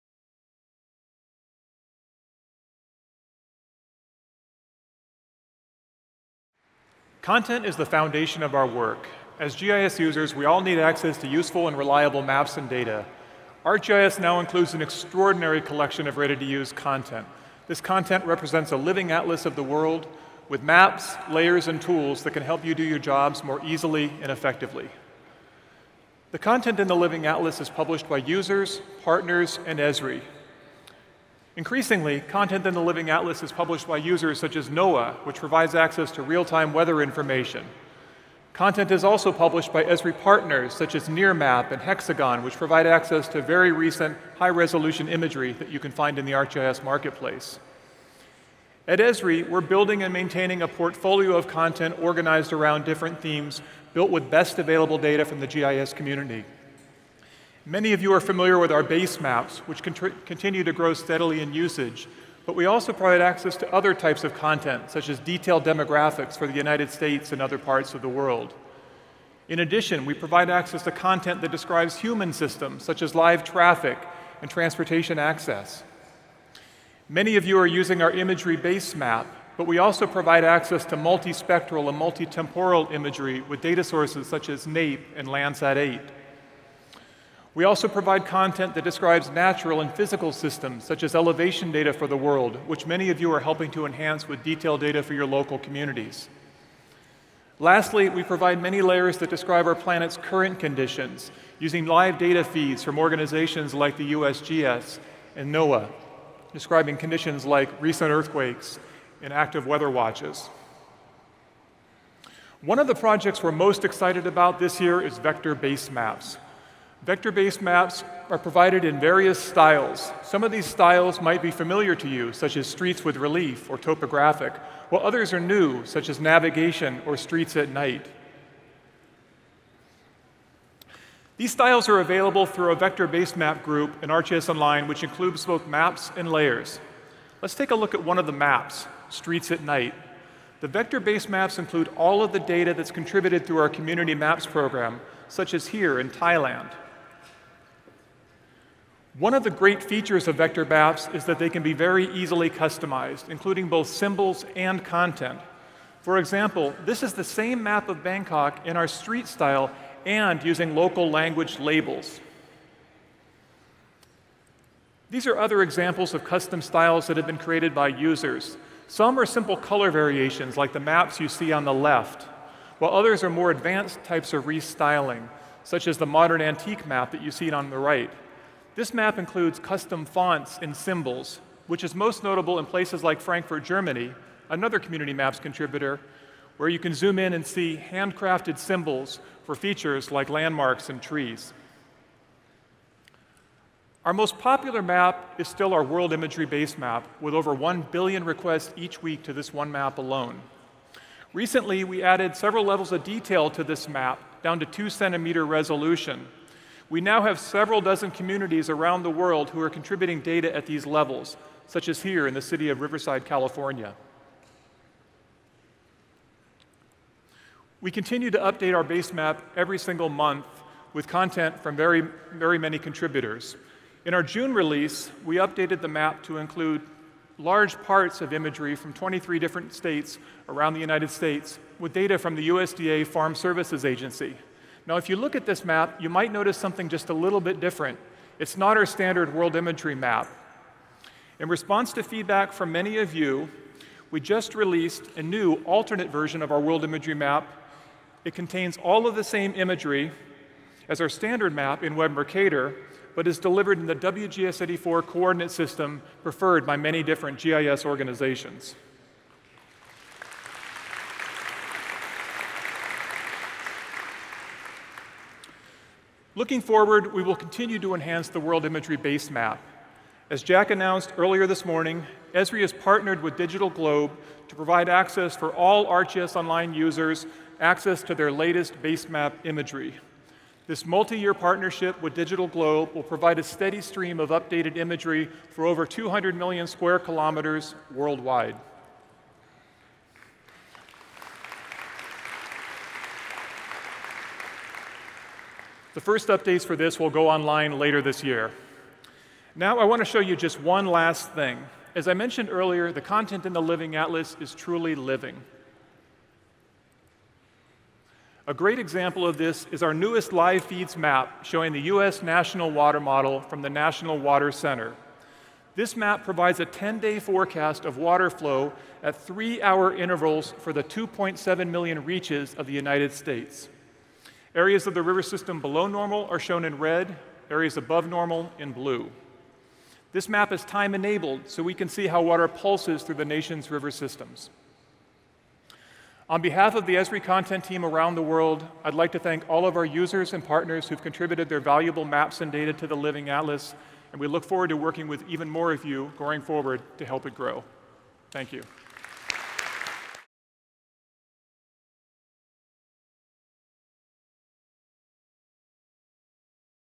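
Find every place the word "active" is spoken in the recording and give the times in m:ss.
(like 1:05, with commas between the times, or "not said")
1:49.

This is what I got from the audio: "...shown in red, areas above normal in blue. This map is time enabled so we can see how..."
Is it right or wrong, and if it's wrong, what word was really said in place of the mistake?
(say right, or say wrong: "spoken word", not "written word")
right.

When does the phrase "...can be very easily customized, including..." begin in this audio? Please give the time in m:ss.
2:31.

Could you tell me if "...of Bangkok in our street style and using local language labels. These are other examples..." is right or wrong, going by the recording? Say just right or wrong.
right.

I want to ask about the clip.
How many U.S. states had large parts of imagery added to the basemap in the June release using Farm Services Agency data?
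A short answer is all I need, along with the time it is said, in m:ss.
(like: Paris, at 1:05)
23, at 3:48.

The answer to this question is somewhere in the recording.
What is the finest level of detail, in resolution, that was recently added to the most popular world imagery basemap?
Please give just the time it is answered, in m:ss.
3:24.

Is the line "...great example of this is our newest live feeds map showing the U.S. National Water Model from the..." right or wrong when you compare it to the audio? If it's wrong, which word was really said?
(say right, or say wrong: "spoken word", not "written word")
right.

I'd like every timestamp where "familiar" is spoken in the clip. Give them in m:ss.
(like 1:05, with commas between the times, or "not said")
0:58, 2:01.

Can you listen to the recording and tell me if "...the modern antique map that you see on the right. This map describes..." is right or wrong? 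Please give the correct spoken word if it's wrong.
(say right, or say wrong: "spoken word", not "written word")
wrong: "includes", not "describes".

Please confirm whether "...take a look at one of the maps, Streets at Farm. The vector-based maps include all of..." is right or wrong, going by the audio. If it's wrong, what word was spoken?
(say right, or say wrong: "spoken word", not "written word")
wrong: "Night", not "Farm".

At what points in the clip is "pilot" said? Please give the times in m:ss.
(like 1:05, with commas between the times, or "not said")
not said.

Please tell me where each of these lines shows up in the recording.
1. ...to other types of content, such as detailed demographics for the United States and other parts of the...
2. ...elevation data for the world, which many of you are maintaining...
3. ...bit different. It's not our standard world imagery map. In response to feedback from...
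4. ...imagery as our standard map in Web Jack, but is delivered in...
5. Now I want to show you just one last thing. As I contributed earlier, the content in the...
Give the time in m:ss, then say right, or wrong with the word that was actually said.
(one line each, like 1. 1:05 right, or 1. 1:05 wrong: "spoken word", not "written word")
1. 1:03 right
2. 1:31 wrong: "helping", not "maintaining"
3. 3:57 right
4. 4:09 wrong: "Mercator", not "Jack"
5. 4:59 wrong: "mentioned", not "contributed".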